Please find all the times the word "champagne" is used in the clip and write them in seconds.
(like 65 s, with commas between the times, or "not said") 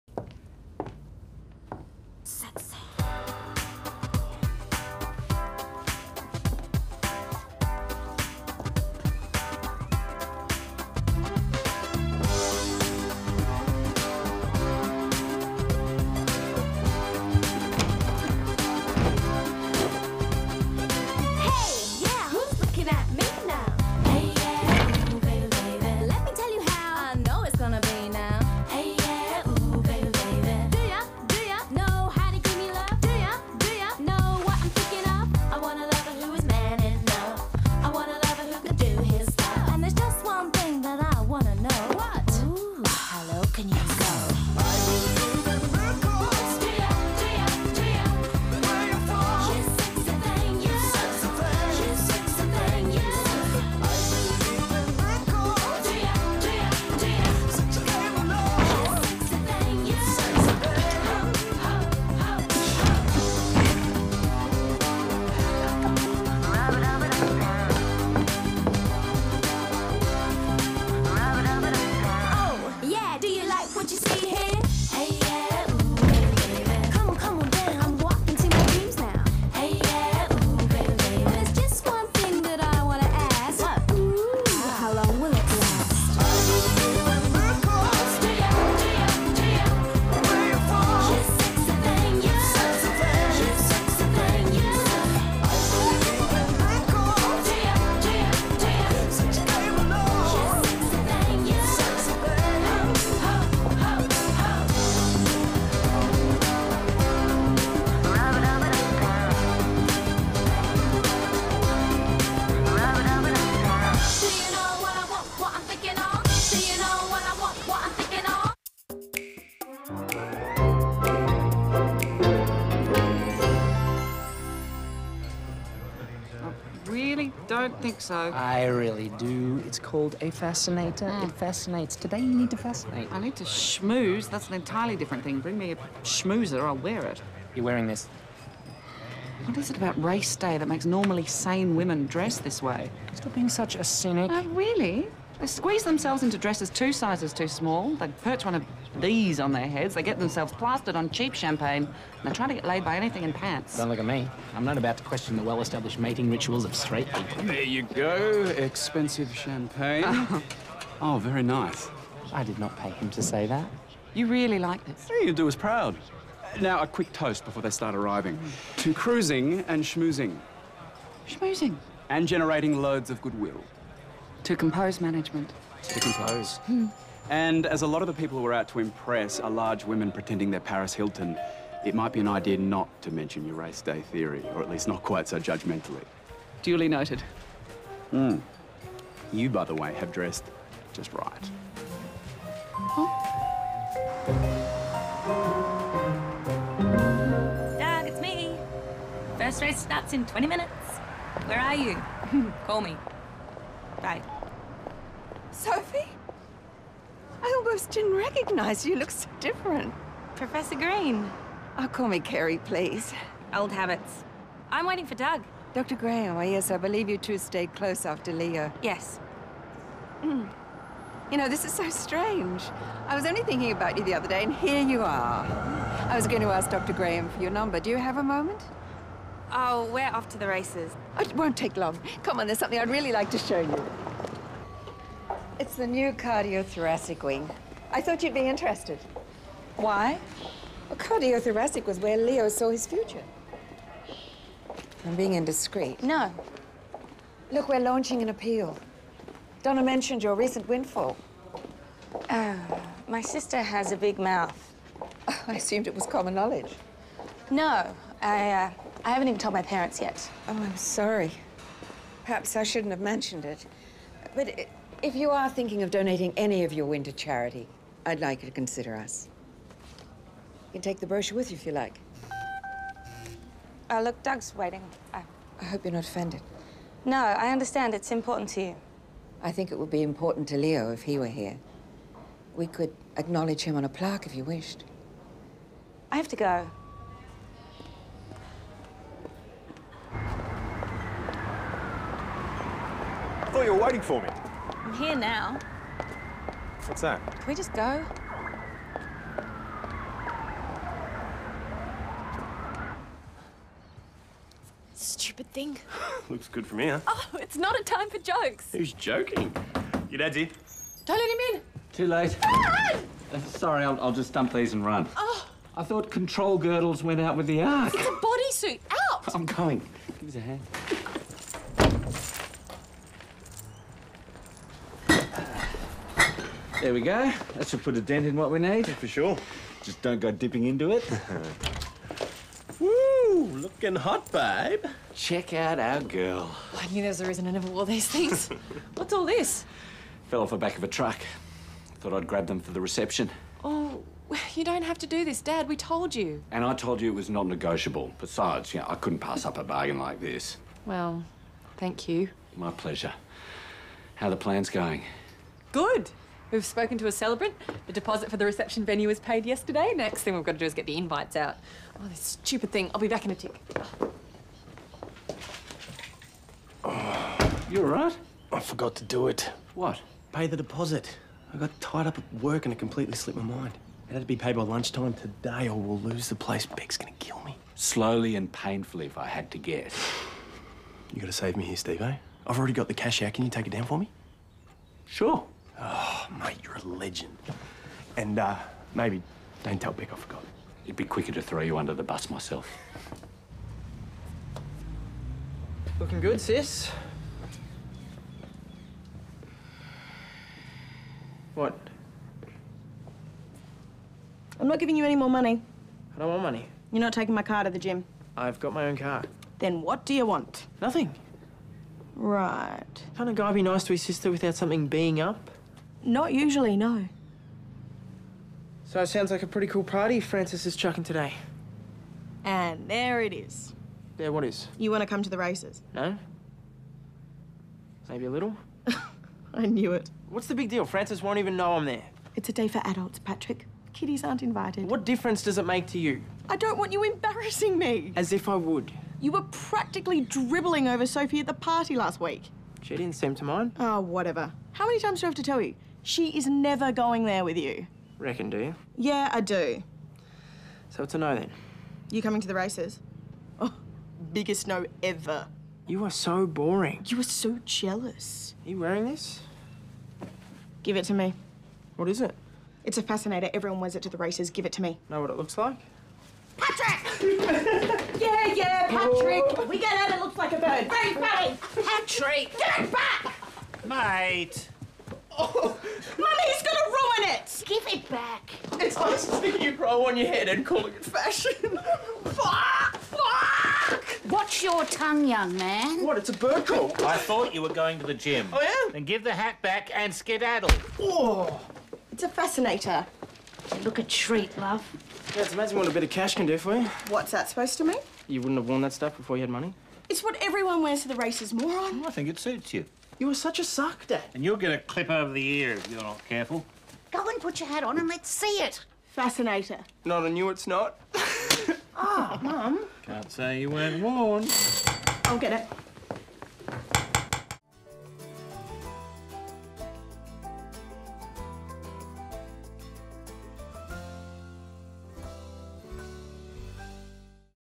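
151 s, 159 s.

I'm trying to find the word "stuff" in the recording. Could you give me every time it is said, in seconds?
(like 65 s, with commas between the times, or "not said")
498 s.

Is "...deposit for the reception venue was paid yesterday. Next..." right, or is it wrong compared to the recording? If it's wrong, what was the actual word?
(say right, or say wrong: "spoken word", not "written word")
right.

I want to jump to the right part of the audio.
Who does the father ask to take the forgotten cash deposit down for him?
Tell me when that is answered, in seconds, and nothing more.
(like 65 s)
381 s.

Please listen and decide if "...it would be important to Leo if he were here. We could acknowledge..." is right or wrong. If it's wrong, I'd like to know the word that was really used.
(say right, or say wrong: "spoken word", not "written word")
right.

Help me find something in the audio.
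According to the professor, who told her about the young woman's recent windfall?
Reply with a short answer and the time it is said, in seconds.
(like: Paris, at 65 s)
Donna, at 249 s.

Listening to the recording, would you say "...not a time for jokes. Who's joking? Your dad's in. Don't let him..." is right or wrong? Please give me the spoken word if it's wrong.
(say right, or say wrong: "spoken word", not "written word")
right.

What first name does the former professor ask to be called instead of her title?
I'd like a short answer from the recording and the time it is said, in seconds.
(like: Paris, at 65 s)
Carrie, at 212 s.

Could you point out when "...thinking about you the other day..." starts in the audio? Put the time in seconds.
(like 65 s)
223 s.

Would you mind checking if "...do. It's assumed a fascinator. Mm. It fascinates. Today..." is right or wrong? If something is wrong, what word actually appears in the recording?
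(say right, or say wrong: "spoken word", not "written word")
wrong: "called", not "assumed".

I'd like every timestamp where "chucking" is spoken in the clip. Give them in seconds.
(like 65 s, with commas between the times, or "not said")
420 s.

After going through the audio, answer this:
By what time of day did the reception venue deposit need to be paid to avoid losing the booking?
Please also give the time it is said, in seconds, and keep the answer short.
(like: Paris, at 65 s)
Lunchtime, at 374 s.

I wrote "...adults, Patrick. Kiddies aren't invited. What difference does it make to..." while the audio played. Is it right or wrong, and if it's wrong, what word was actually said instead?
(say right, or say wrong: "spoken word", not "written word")
right.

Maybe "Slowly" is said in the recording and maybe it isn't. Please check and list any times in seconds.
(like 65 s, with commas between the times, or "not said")
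377 s.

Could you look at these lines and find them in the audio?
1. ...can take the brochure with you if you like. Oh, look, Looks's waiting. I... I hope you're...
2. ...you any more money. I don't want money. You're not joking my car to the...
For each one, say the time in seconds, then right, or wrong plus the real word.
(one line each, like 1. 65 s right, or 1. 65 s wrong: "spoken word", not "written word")
1. 270 s wrong: "Doug", not "Looks"
2. 404 s wrong: "taking", not "joking".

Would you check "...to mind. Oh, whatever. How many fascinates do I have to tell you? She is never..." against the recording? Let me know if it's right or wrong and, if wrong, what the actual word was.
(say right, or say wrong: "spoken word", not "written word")
wrong: "times", not "fascinates".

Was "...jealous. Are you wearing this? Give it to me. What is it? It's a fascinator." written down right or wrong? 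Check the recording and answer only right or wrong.
right.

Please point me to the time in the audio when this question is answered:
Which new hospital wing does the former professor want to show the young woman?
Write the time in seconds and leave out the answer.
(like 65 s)
236 s.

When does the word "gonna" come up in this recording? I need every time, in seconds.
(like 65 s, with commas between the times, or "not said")
376 s, 476 s.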